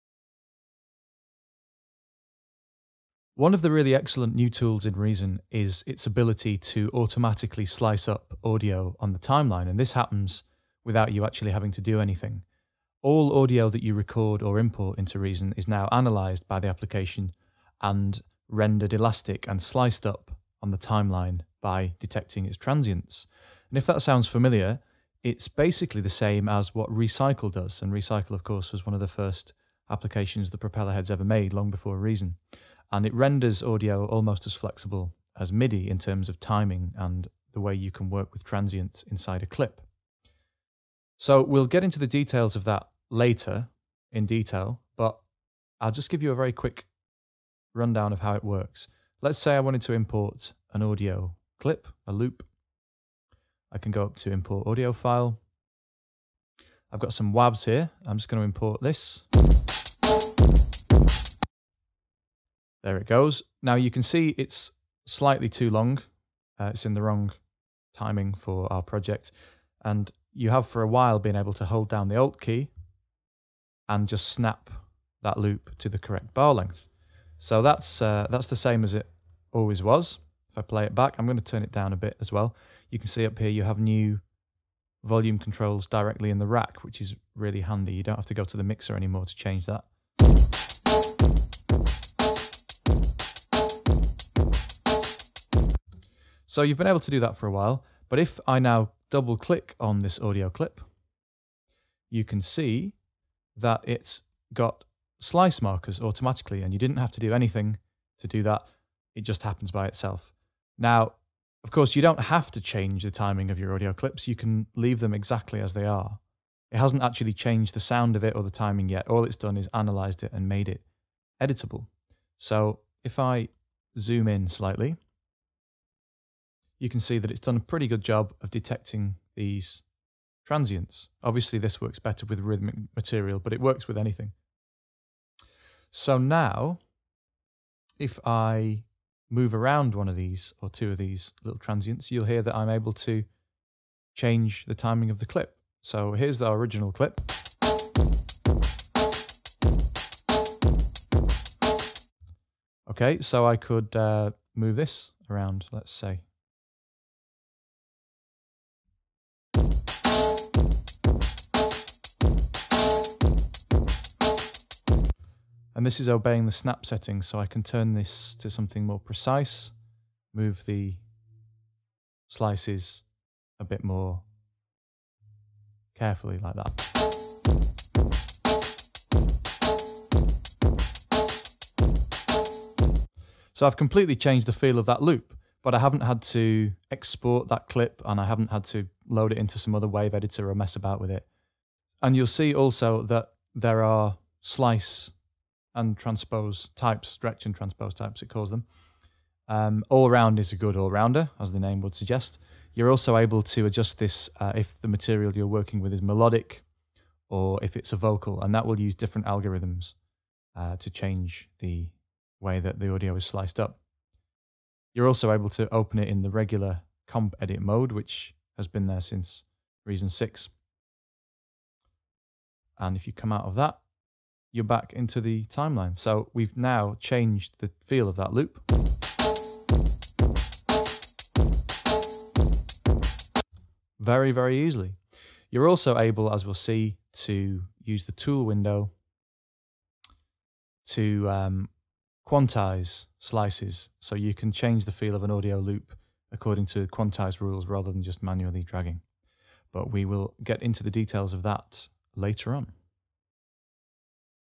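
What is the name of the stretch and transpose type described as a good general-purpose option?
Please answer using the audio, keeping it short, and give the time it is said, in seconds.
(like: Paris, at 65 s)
All round, at 199 s.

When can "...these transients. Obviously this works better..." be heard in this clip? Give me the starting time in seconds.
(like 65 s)
129 s.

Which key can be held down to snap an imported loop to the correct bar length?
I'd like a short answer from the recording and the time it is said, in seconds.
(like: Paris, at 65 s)
Alt, at 72 s.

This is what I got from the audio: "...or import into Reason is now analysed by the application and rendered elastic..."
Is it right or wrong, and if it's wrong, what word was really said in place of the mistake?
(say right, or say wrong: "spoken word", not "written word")
right.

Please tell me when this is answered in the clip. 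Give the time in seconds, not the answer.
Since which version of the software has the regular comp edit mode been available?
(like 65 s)
219 s.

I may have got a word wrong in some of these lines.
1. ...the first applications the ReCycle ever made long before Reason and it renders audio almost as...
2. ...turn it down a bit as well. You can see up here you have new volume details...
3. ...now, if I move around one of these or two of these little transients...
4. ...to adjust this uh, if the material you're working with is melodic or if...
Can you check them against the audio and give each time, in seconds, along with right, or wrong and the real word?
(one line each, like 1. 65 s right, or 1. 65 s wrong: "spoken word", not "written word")
1. 28 s wrong: "Propellerheads", not "ReCycle"
2. 81 s wrong: "controls", not "details"
3. 136 s right
4. 203 s right.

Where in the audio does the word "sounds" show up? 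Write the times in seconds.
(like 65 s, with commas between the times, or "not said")
24 s, 117 s.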